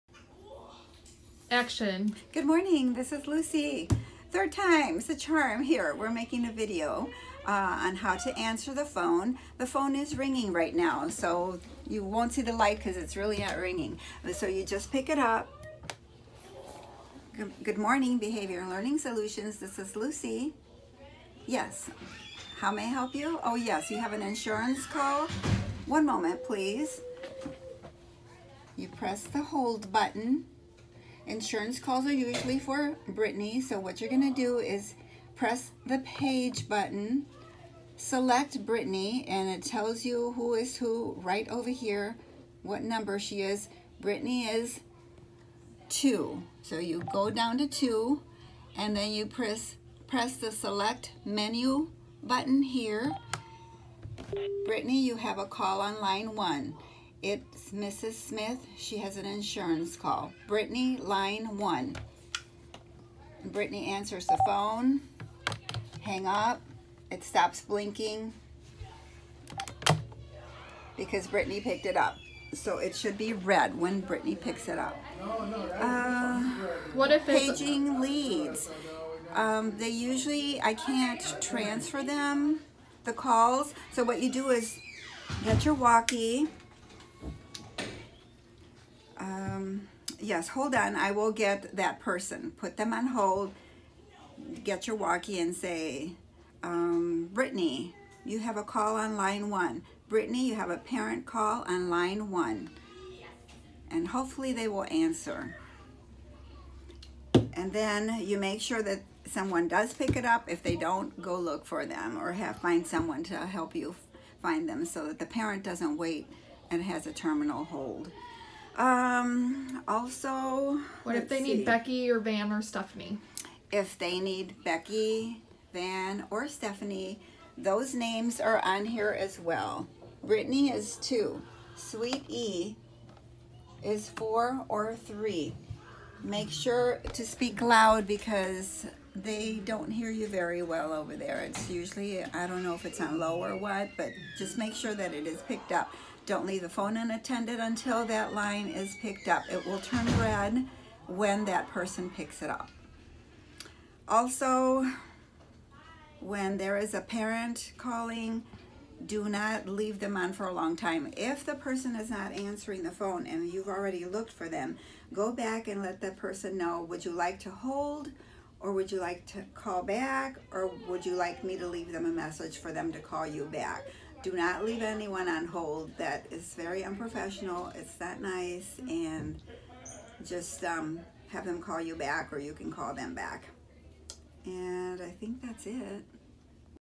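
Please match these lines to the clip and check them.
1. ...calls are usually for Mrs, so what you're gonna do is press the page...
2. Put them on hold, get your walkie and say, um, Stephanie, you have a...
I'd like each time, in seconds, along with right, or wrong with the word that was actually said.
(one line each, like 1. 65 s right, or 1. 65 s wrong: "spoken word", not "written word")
1. 31 s wrong: "Brittany", not "Mrs"
2. 92 s wrong: "Brittany", not "Stephanie".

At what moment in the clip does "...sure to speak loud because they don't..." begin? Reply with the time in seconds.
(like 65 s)
136 s.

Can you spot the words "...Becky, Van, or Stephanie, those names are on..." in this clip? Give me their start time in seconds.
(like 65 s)
124 s.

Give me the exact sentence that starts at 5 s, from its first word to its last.
We're making a video uh, on how to answer the phone.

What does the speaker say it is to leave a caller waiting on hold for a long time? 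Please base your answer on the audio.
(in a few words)
very unprofessional.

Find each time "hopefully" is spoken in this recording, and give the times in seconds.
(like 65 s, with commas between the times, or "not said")
104 s.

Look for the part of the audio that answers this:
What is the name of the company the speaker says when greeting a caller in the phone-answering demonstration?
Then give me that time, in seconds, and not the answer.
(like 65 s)
18 s.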